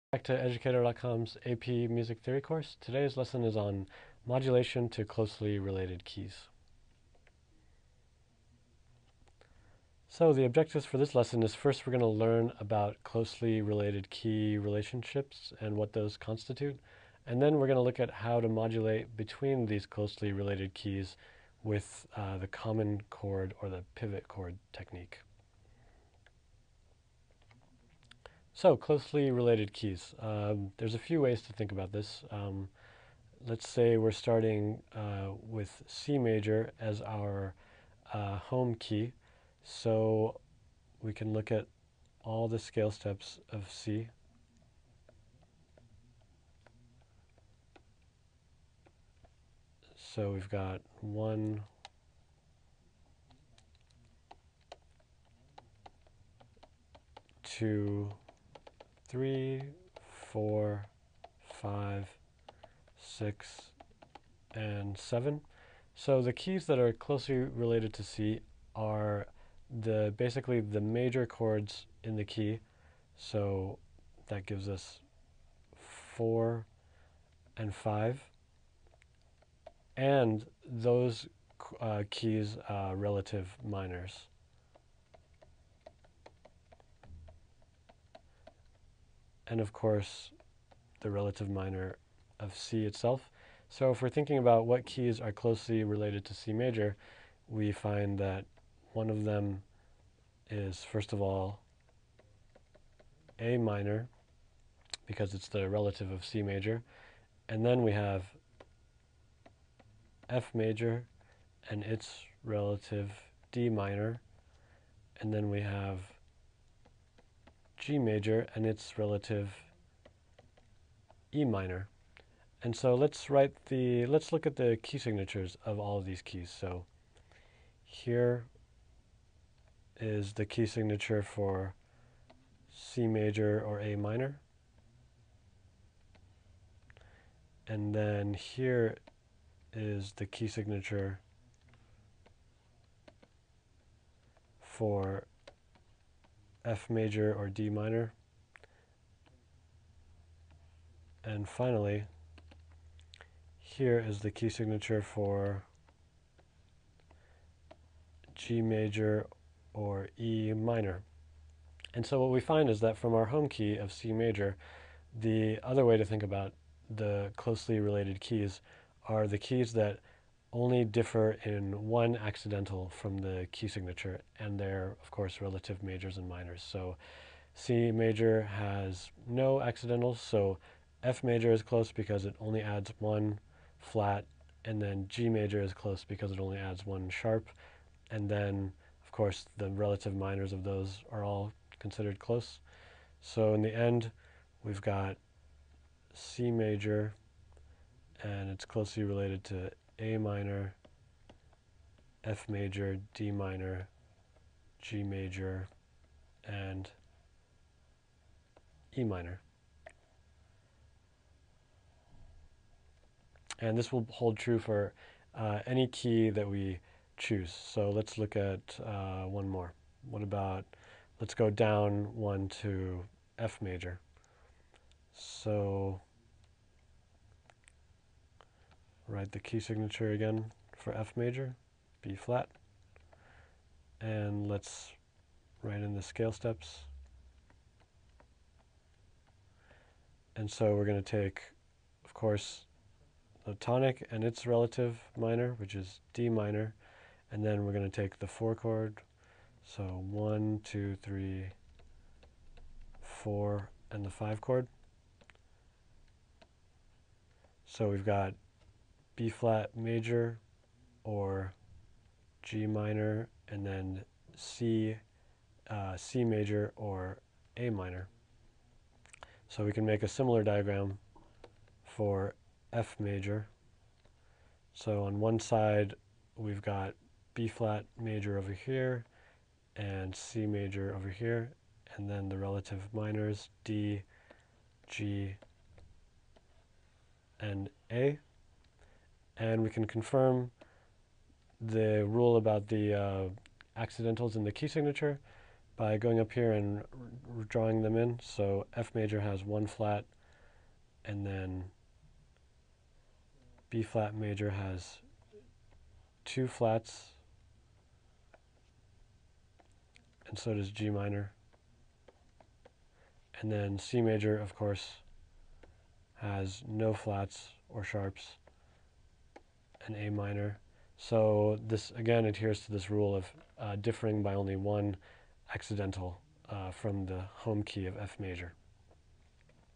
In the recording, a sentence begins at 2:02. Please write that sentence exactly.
And so let's write the, let's look at the key signatures of all of these keys.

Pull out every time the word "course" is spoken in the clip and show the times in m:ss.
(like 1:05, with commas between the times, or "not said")
0:02, 1:29, 2:55, 3:09, 4:02, 5:14.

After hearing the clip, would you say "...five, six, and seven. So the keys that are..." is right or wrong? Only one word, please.
right.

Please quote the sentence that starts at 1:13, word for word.
So that gives us four and five, and those uh, keys uh, relative minors.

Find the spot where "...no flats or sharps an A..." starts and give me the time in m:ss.
5:16.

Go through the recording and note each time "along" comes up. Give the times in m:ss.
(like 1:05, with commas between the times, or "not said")
not said.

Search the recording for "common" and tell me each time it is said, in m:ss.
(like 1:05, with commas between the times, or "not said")
0:22.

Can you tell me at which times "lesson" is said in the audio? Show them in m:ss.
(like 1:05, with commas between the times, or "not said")
0:03, 0:11.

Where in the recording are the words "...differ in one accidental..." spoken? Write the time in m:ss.
2:50.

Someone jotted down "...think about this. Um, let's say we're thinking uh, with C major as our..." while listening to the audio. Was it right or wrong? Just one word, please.
wrong.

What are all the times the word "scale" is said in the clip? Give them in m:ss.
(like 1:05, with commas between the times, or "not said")
0:42, 3:56.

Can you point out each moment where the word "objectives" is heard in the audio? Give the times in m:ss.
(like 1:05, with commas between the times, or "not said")
0:10.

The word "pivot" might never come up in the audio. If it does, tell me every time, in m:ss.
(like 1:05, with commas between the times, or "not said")
0:23.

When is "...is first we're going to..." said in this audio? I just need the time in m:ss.
0:11.